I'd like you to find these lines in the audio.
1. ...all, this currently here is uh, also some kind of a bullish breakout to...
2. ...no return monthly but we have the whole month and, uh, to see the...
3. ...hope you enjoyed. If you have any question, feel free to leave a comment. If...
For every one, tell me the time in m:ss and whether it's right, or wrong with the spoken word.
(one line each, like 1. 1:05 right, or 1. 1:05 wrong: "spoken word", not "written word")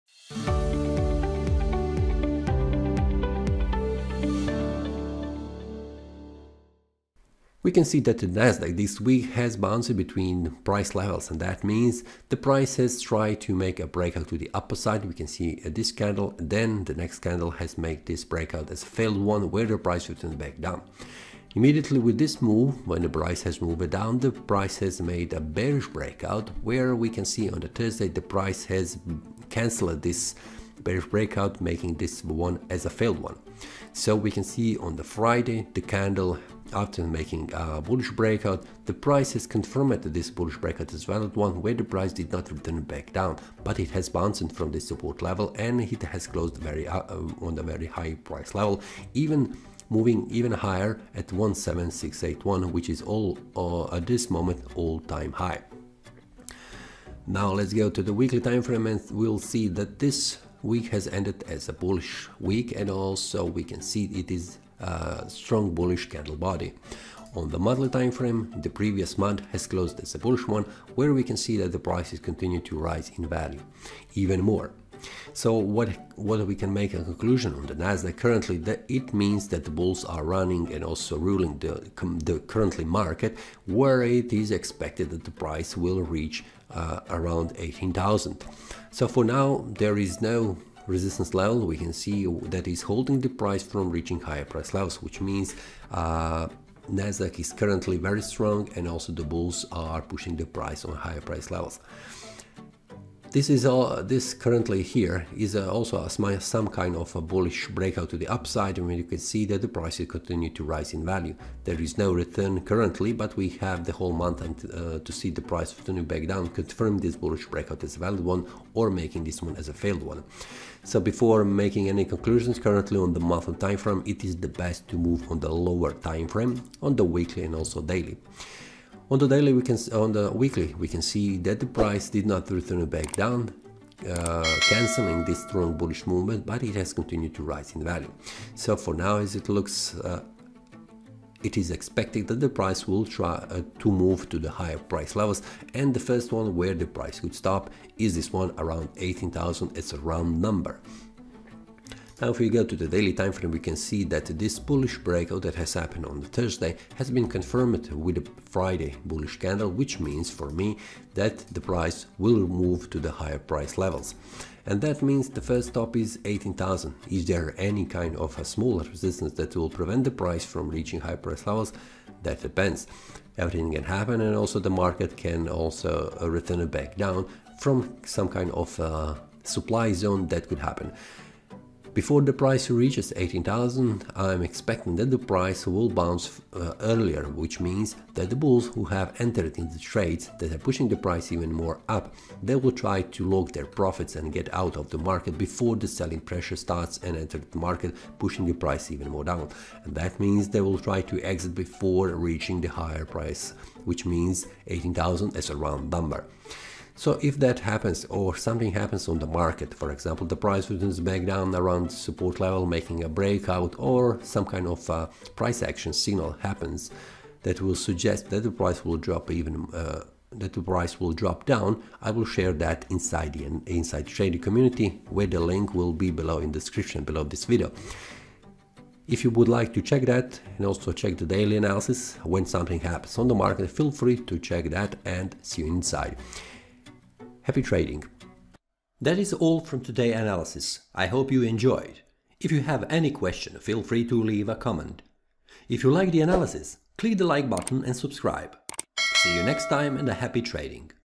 1. 1:43 right
2. 1:51 wrong: "currently", not "monthly"
3. 4:01 right.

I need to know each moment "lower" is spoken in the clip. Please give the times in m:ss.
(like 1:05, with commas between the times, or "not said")
2:05.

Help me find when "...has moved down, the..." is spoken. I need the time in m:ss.
0:23.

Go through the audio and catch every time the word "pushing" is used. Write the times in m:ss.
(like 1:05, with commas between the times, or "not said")
1:40, 3:10, 3:18.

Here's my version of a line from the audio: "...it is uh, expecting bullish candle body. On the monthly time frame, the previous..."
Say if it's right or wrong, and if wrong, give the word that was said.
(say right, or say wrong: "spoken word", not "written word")
wrong: "strong", not "expecting".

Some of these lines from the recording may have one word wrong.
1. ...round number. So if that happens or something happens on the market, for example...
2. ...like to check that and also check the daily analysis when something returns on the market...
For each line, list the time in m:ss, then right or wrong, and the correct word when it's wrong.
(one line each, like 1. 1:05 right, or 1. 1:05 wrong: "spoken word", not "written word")
1. 3:25 right
2. 3:49 wrong: "happens", not "returns".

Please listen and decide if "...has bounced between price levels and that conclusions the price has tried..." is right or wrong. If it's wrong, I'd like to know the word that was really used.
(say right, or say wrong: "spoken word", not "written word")
wrong: "means", not "conclusions".